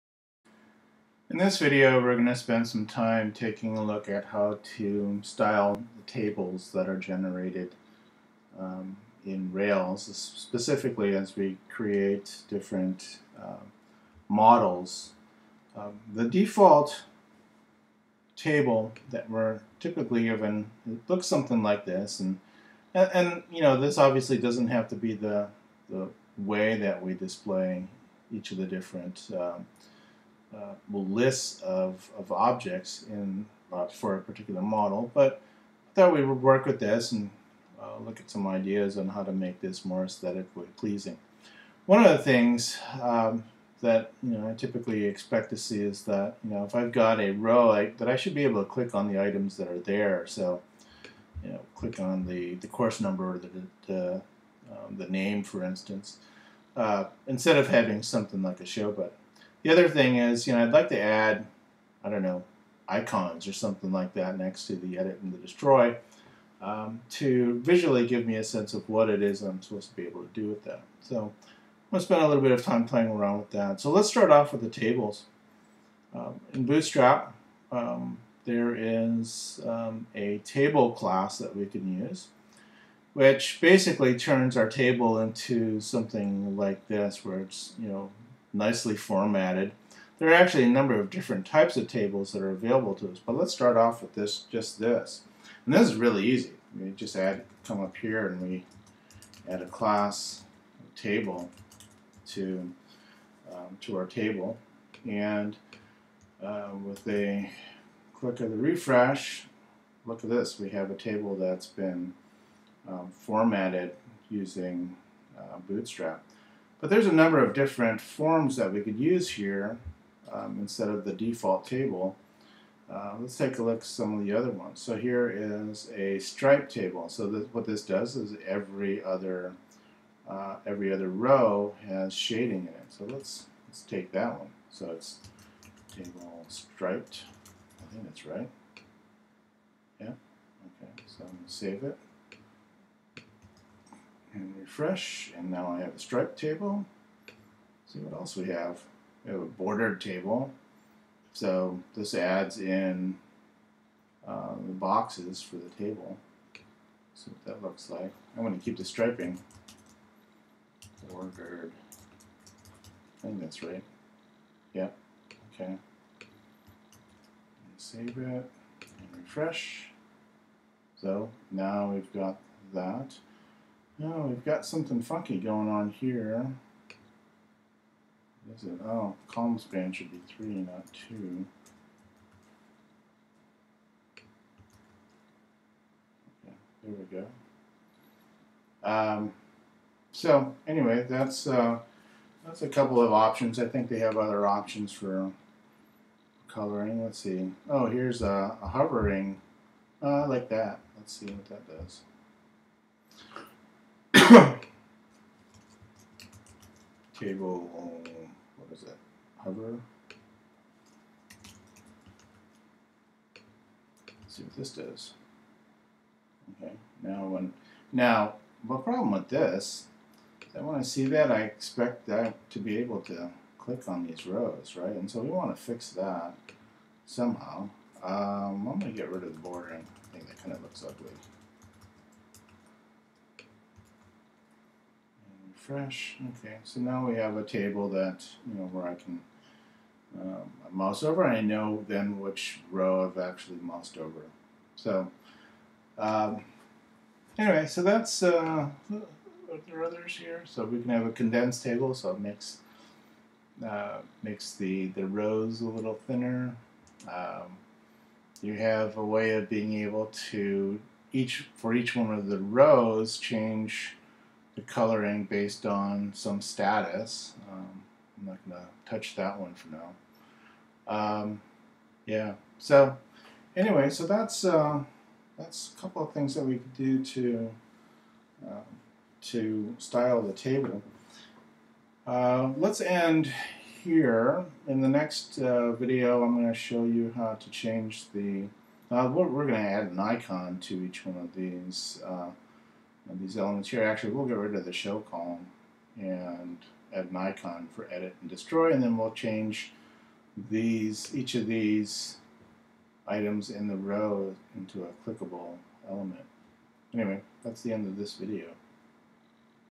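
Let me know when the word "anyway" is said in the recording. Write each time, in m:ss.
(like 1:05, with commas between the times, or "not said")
3:10, 4:07, 4:33, 5:06.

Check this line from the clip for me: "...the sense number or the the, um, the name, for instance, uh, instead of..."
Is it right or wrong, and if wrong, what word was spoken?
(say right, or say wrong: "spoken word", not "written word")
wrong: "course", not "sense".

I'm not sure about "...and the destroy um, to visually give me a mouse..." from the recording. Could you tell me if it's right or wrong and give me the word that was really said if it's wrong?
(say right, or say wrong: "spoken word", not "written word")
wrong: "sense", not "mouse".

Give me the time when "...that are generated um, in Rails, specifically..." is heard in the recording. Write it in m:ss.
0:06.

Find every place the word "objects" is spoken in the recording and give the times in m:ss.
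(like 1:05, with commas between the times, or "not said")
0:32.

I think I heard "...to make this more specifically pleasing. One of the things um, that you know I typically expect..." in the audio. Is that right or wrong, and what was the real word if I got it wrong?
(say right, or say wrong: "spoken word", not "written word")
wrong: "aesthetically", not "specifically".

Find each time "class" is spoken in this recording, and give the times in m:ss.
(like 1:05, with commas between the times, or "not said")
1:20, 1:39.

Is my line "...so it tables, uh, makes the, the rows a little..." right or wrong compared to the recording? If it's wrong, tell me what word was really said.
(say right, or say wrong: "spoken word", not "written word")
wrong: "makes", not "tables".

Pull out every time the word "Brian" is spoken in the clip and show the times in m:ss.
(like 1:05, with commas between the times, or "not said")
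not said.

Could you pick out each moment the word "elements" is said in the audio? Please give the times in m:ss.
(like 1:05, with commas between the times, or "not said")
4:53, 5:05.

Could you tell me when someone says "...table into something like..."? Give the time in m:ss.
1:24.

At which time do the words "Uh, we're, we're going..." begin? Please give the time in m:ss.
4:48.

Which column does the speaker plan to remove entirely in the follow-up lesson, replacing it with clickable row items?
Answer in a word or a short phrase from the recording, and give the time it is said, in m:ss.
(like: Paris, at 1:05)
show column, at 4:54.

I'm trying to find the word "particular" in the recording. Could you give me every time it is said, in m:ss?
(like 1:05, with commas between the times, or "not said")
0:34.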